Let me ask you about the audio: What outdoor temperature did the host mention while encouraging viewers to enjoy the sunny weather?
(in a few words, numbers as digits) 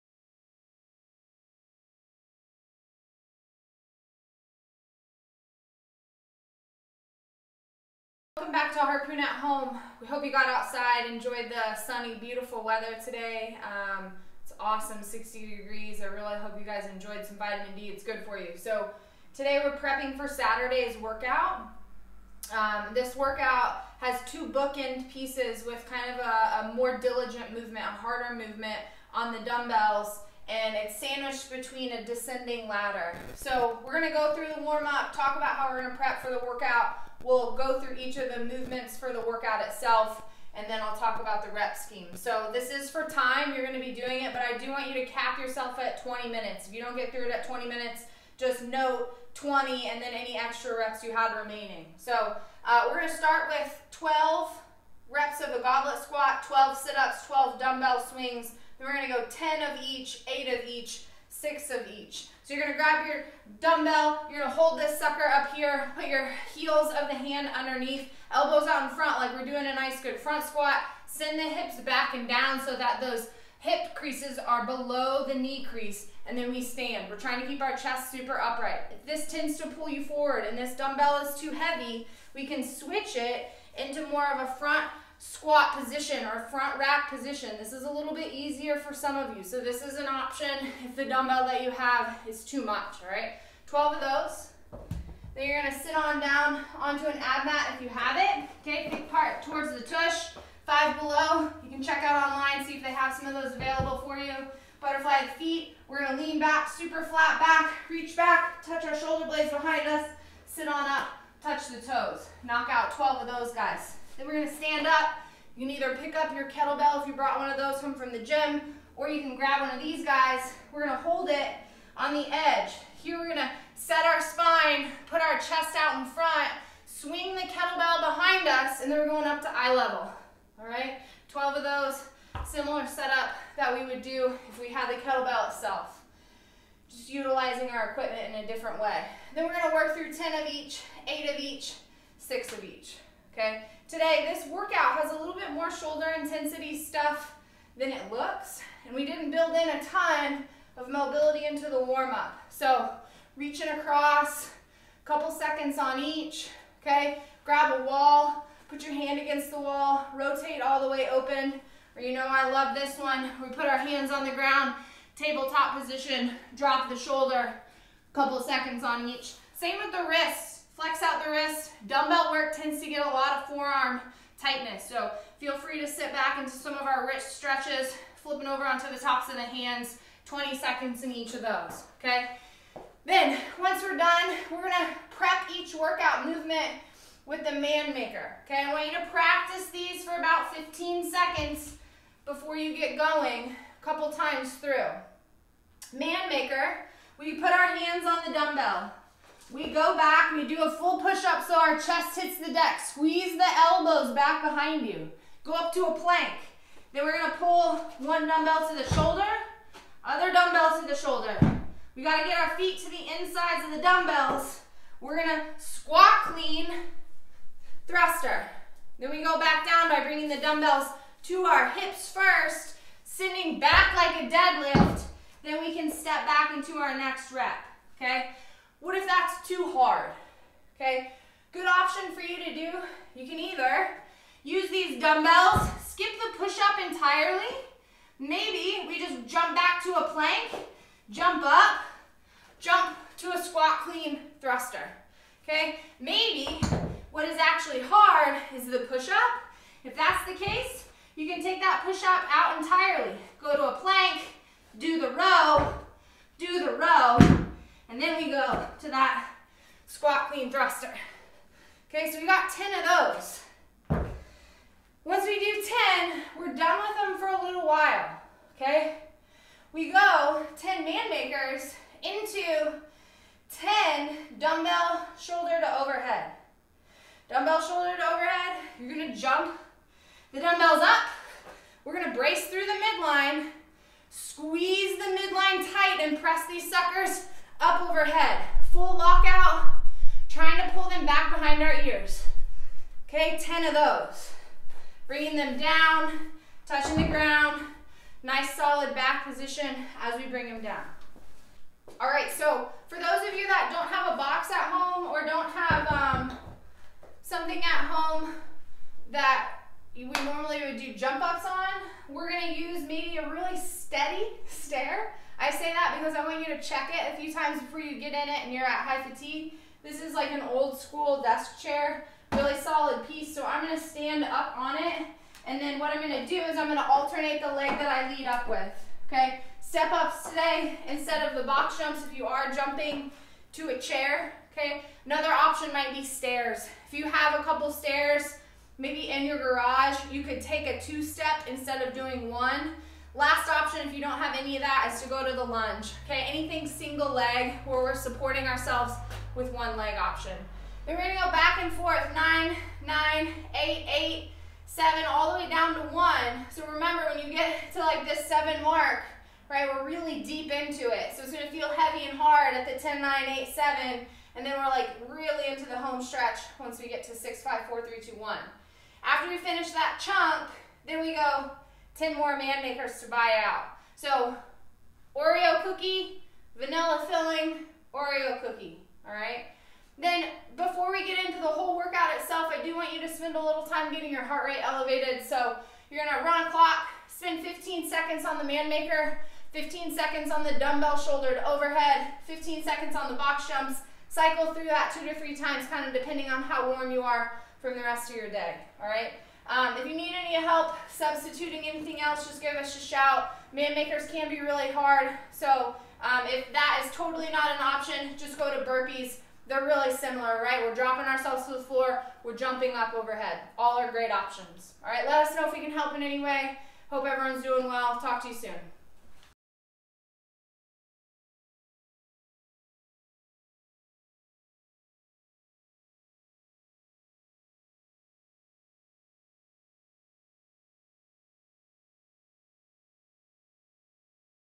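60 degrees.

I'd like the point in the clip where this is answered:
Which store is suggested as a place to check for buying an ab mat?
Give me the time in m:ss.
1:40.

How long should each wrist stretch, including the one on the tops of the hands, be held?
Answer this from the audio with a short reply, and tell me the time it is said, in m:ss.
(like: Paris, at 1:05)
20 seconds, at 3:00.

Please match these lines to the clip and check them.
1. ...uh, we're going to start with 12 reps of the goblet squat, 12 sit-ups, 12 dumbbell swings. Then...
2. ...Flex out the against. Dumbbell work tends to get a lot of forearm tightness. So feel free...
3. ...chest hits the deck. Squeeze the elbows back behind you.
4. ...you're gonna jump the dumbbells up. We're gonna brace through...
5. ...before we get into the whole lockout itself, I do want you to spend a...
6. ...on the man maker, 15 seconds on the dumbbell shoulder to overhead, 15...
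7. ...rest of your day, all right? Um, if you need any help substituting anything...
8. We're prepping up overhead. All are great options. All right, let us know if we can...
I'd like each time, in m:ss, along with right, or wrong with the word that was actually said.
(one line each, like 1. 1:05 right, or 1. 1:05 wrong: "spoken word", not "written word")
1. 0:52 right
2. 2:50 wrong: "wrist", not "against"
3. 3:21 right
4. 4:38 right
5. 6:20 wrong: "workout", not "lockout"
6. 6:28 right
7. 6:37 right
8. 6:52 wrong: "jumping", not "prepping".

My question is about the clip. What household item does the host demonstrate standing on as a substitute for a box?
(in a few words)
old school desk chair.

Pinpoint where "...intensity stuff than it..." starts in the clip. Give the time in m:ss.
2:26.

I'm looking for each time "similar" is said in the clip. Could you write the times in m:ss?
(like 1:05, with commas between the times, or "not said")
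2:12, 6:49.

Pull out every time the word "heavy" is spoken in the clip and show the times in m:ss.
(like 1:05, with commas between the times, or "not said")
1:21, 6:01.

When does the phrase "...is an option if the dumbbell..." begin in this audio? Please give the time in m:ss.
1:29.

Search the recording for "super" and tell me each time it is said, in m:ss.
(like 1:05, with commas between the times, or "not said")
1:18, 1:46.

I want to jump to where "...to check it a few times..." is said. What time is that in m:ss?
5:16.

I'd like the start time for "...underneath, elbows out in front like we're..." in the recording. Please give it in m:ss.
1:07.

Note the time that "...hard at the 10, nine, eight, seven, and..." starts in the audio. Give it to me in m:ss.
6:02.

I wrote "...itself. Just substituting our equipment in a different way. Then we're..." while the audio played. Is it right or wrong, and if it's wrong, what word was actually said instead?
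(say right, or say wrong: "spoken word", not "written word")
wrong: "utilizing", not "substituting".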